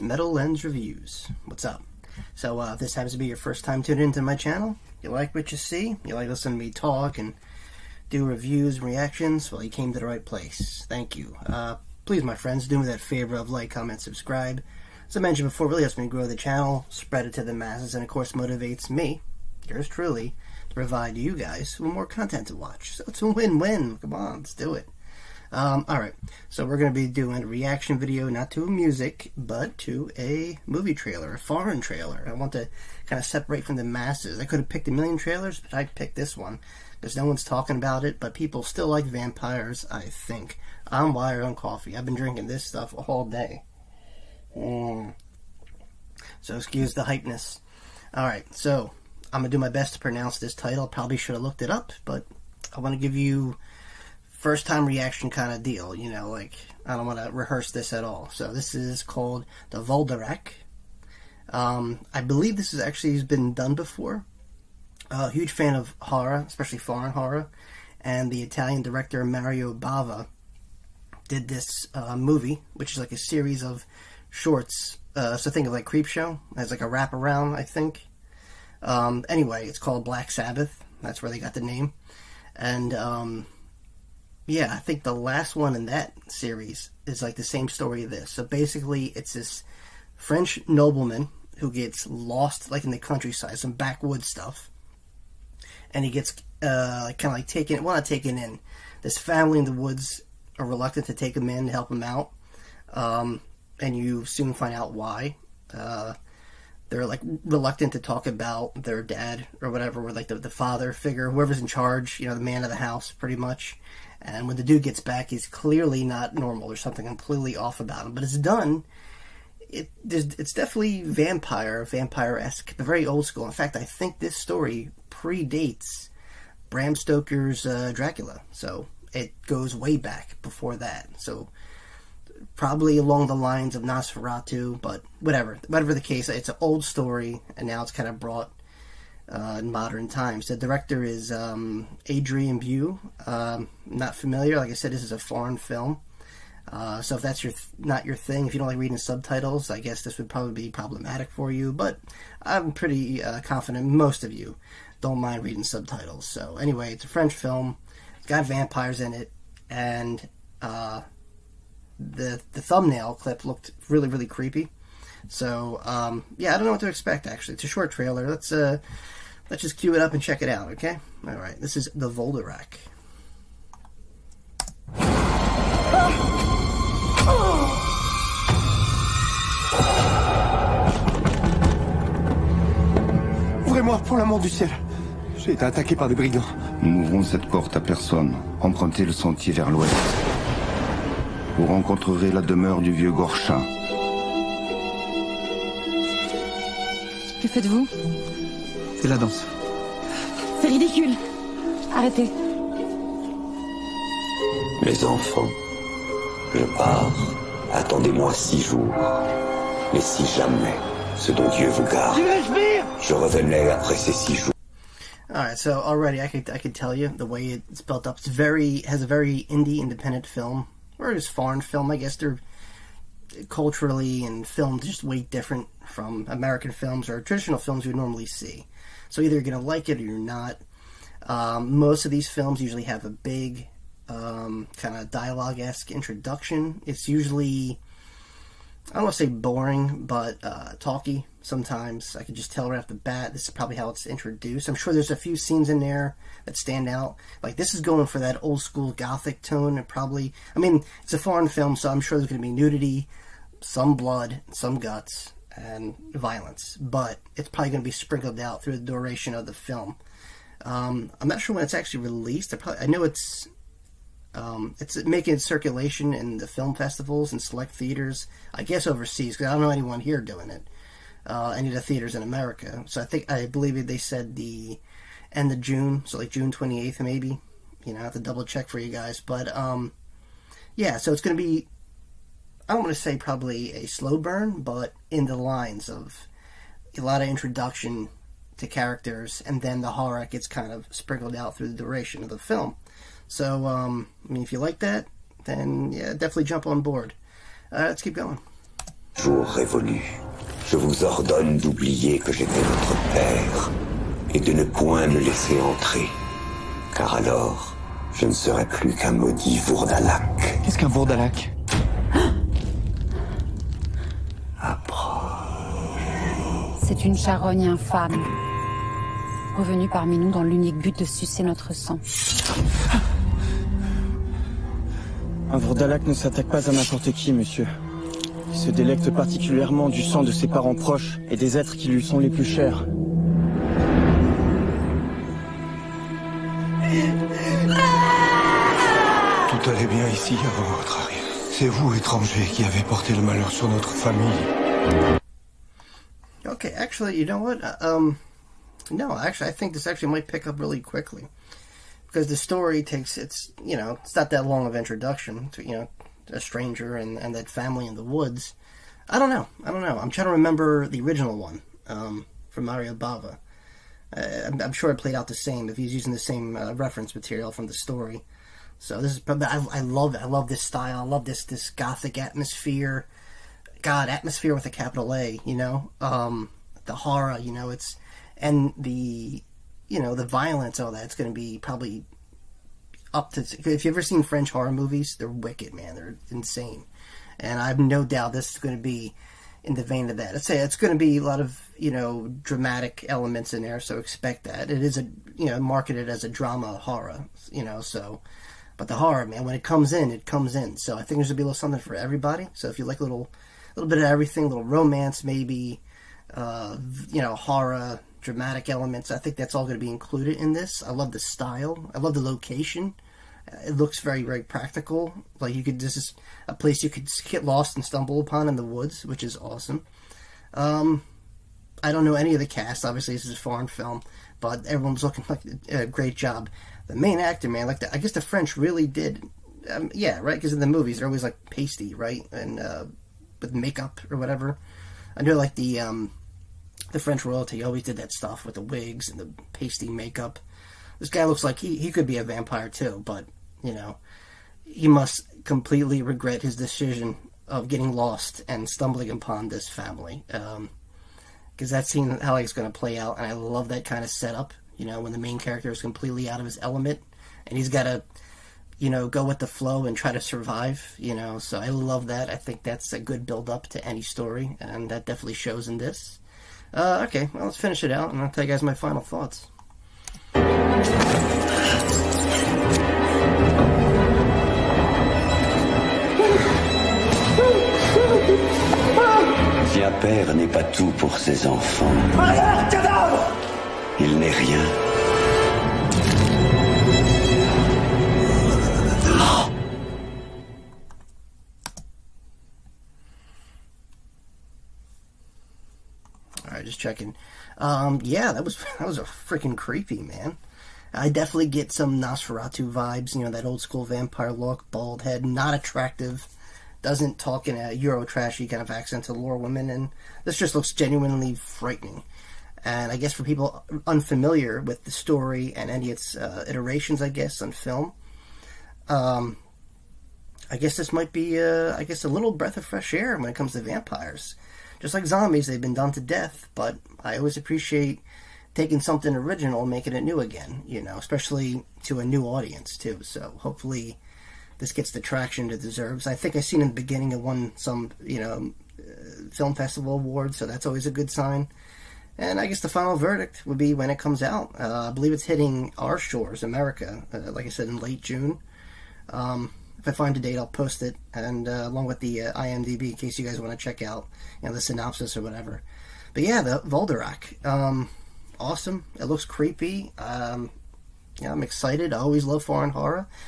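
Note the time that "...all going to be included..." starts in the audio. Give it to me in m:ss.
6:49.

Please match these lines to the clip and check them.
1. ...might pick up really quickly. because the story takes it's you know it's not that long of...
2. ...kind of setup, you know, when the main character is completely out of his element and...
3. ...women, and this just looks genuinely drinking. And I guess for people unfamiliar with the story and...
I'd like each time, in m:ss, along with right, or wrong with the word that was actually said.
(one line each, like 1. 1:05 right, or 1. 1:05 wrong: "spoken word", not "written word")
1. 5:50 right
2. 7:33 right
3. 8:29 wrong: "frightening", not "drinking".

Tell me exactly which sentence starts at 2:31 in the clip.
But I'm pretty uh, confident most of you don't mind reading subtitles.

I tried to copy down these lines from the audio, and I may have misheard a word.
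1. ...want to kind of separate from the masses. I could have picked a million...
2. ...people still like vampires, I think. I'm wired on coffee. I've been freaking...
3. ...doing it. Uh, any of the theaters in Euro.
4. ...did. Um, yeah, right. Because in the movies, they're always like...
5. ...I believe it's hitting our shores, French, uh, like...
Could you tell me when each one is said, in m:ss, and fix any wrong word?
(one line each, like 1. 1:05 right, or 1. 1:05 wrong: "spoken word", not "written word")
1. 0:32 right
2. 0:38 wrong: "drinking", not "freaking"
3. 4:30 wrong: "America", not "Euro"
4. 7:08 right
5. 9:04 wrong: "America", not "French".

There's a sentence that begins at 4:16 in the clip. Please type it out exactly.
But it's probably gonna be sprinkled out through the duration of the film.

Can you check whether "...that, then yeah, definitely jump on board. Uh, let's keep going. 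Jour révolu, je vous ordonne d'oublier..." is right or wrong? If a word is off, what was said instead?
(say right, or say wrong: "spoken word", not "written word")
right.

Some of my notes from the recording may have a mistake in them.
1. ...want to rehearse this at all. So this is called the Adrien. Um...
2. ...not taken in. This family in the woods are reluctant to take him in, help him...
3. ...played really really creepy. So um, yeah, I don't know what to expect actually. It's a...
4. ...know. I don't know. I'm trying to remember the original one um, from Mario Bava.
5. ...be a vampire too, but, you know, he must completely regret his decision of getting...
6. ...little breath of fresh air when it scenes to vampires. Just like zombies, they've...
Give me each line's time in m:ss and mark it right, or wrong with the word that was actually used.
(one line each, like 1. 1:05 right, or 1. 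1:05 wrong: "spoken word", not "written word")
1. 0:57 wrong: "Volderek", not "Adrien"
2. 1:37 right
3. 2:43 wrong: "looked", not "played"
4. 5:59 right
5. 7:22 right
6. 8:42 wrong: "comes", not "scenes".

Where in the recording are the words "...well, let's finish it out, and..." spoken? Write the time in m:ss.
7:47.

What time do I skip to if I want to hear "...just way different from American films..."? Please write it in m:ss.
3:44.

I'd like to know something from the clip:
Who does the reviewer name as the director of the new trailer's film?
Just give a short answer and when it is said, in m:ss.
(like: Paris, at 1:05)
Adrien Bue, at 2:22.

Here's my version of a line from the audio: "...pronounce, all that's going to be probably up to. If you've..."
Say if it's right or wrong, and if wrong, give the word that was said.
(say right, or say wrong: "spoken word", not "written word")
wrong: "violence", not "pronounce".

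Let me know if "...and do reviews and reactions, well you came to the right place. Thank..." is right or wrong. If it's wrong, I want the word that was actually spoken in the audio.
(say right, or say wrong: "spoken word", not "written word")
right.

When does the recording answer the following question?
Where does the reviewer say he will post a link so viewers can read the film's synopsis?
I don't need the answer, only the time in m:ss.
9:12.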